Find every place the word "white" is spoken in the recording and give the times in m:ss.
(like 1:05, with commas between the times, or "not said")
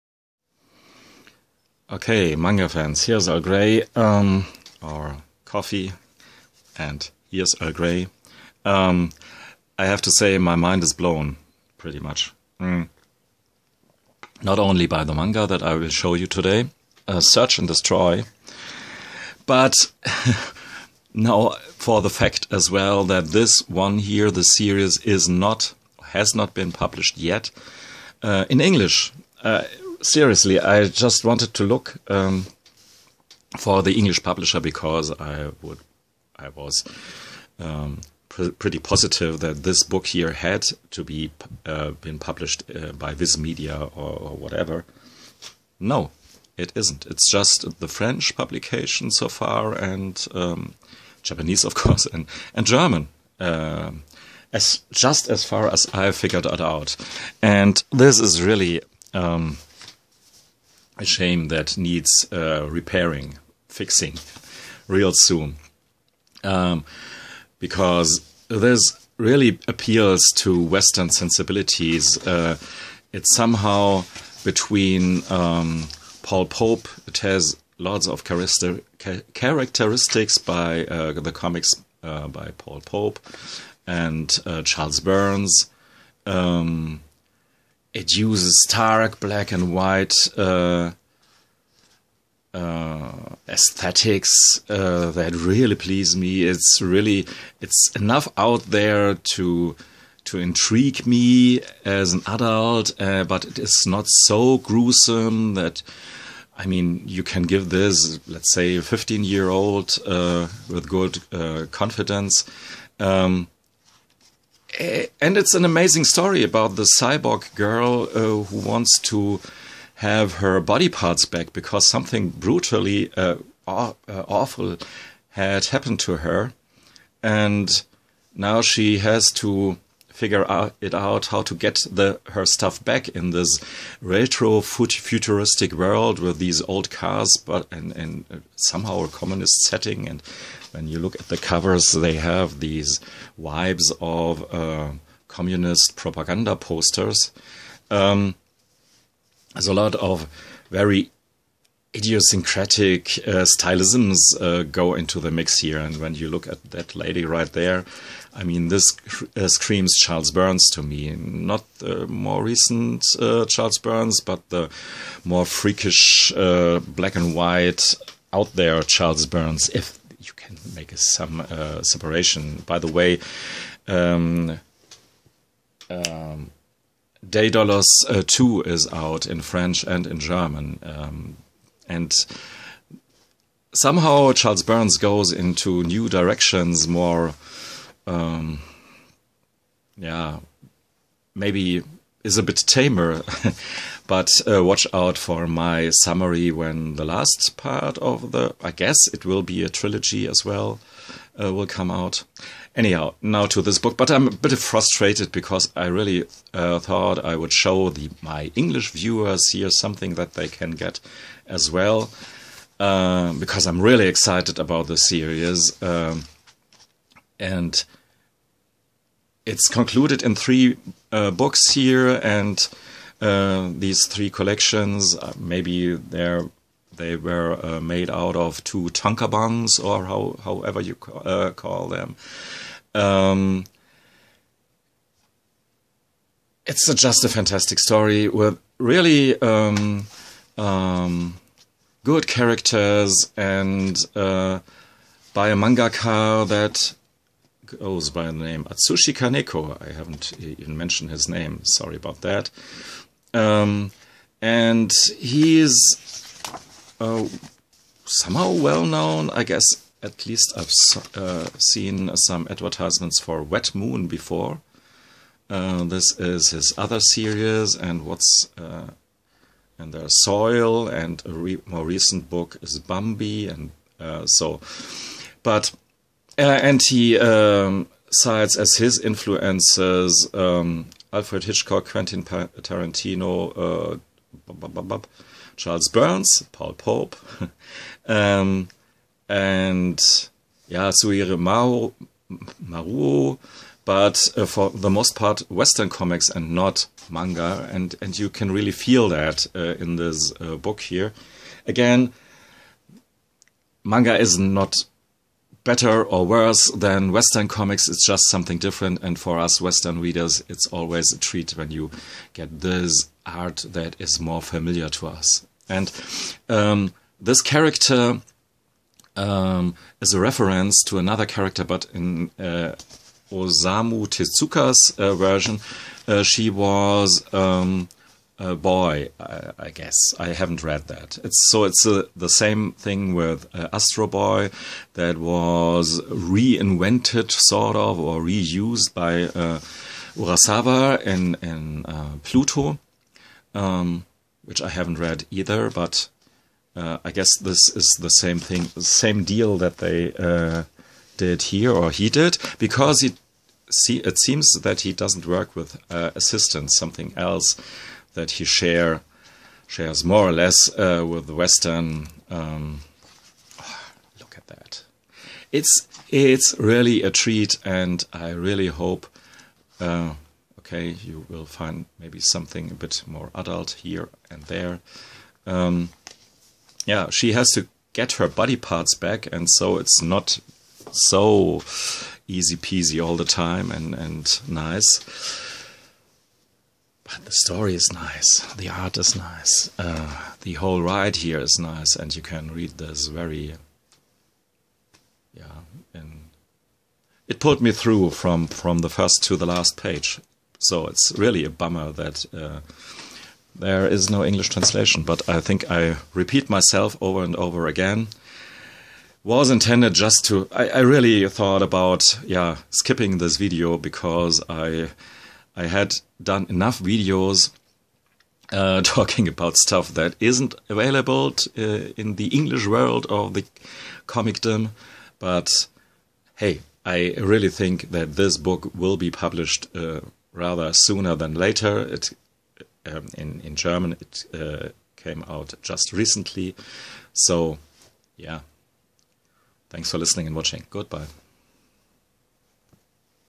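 1:29, 2:47.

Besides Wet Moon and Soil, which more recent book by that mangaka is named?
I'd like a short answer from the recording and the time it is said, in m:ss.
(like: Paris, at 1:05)
Bambi, at 4:32.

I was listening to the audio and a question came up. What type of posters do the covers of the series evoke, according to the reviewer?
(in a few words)
Communist propaganda posters.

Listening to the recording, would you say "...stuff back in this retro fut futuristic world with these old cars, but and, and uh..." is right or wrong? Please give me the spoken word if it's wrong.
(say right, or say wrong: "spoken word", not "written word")
right.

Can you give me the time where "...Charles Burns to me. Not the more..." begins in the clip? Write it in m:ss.
2:39.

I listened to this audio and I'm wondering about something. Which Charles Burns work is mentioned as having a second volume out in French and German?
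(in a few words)
Daedalus.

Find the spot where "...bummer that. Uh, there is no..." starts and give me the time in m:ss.
6:41.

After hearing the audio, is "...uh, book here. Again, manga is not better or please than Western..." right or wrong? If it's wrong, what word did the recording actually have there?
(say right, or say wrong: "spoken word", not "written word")
wrong: "worse", not "please".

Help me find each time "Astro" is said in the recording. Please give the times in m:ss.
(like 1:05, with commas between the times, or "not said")
5:33.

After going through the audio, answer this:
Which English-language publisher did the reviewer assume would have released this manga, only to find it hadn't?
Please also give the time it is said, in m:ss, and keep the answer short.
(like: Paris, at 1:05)
Viz Media, at 0:43.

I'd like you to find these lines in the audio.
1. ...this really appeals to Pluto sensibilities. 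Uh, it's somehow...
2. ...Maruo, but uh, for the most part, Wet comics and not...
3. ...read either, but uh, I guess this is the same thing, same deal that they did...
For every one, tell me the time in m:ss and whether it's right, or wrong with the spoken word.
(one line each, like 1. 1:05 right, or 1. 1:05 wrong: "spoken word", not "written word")
1. 1:08 wrong: "Western", not "Pluto"
2. 4:52 wrong: "Western", not "Wet"
3. 5:44 right.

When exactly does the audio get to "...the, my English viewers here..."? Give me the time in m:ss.
3:27.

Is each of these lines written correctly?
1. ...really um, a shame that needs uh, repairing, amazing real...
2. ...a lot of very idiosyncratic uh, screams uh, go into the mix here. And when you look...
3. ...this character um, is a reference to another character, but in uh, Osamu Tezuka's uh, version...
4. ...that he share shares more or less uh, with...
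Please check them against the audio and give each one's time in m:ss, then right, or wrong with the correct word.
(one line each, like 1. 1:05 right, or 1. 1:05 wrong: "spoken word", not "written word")
1. 0:58 wrong: "fixing", not "amazing"
2. 2:29 wrong: "stylisms", not "screams"
3. 5:17 right
4. 5:58 right.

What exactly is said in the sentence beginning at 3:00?
Um, and somehow Charles Burns goes into new directions, more, um, yeah, maybe is a bit tamer.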